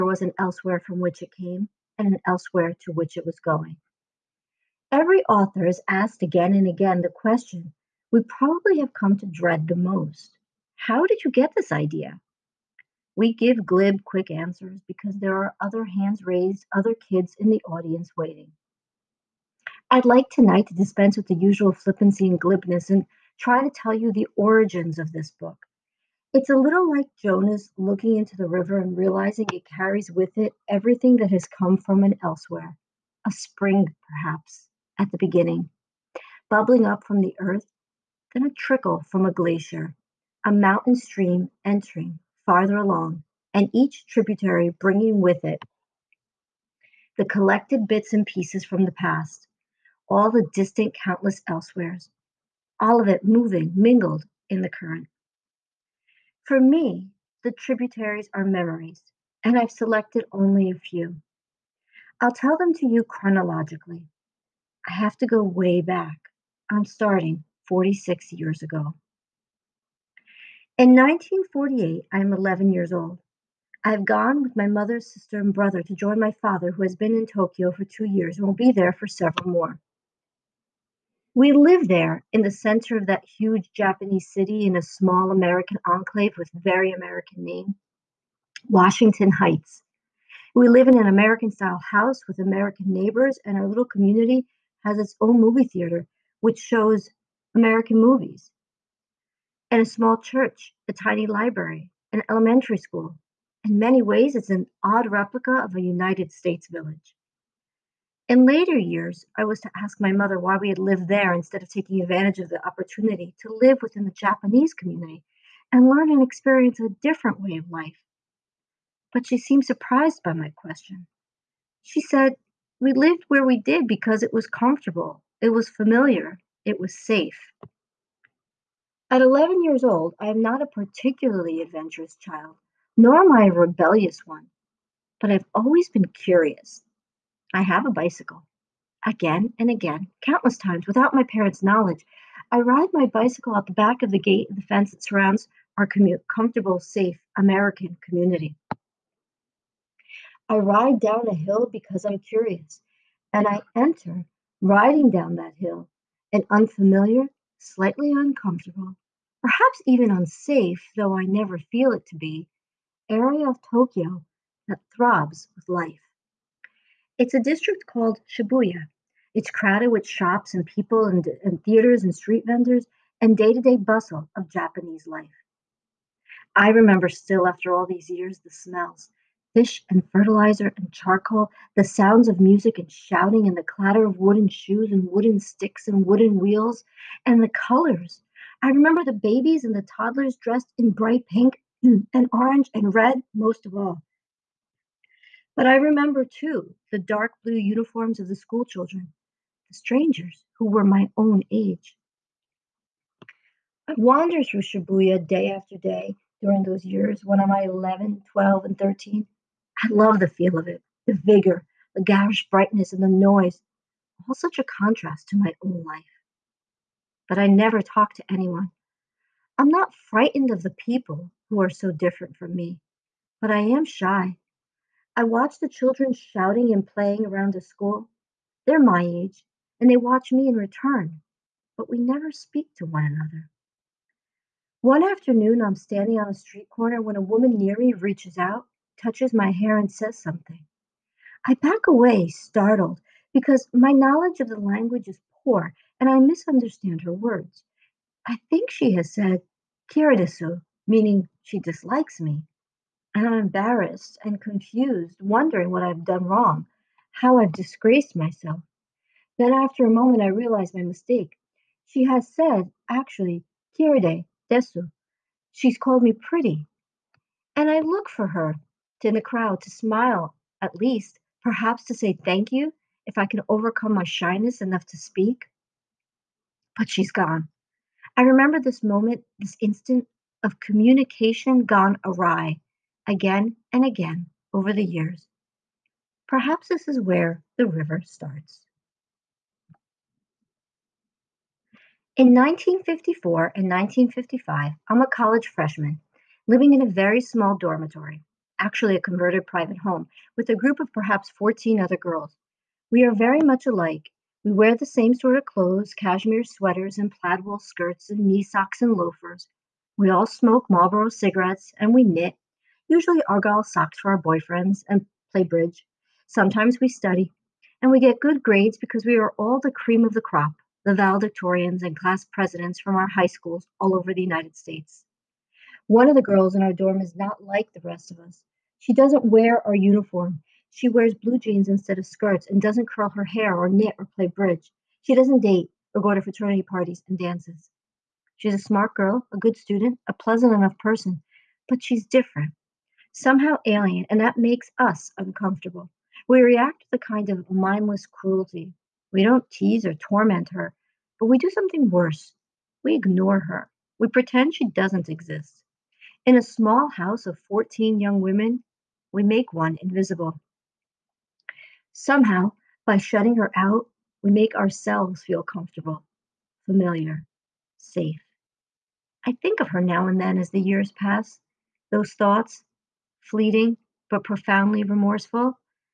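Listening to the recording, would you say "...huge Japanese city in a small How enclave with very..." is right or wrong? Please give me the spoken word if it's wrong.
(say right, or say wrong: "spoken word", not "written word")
wrong: "American", not "How".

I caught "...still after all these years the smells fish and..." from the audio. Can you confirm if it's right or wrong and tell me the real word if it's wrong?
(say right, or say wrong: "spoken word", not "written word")
right.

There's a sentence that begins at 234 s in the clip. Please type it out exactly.
One afternoon, I'm standing on a street corner when a woman near me reaches out, touches my hair, and says something.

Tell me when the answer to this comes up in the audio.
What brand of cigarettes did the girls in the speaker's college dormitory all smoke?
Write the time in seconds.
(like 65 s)
310 s.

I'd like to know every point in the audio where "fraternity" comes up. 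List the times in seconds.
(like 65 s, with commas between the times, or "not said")
336 s.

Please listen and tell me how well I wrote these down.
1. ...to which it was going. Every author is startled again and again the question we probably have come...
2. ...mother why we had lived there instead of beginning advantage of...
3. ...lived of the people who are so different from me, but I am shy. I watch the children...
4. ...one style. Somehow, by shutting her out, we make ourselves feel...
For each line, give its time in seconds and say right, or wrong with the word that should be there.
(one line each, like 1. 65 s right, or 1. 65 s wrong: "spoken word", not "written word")
1. 2 s wrong: "asked", not "startled"
2. 110 s wrong: "taking", not "beginning"
3. 220 s wrong: "frightened", not "lived"
4. 359 s wrong: "invisible", not "style".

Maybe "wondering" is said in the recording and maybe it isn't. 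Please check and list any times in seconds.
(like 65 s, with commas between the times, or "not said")
255 s.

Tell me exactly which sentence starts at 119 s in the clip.
But she seemed surprised by my question.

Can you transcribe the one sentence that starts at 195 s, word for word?
But I remember too the dark blue uniforms of the school children, the strangers who were my own age.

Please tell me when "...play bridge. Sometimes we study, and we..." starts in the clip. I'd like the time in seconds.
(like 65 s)
315 s.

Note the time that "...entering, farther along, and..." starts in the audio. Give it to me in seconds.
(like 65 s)
41 s.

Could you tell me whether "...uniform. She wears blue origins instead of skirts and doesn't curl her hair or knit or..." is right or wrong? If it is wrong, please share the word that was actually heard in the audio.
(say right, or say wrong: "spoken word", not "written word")
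wrong: "jeans", not "origins".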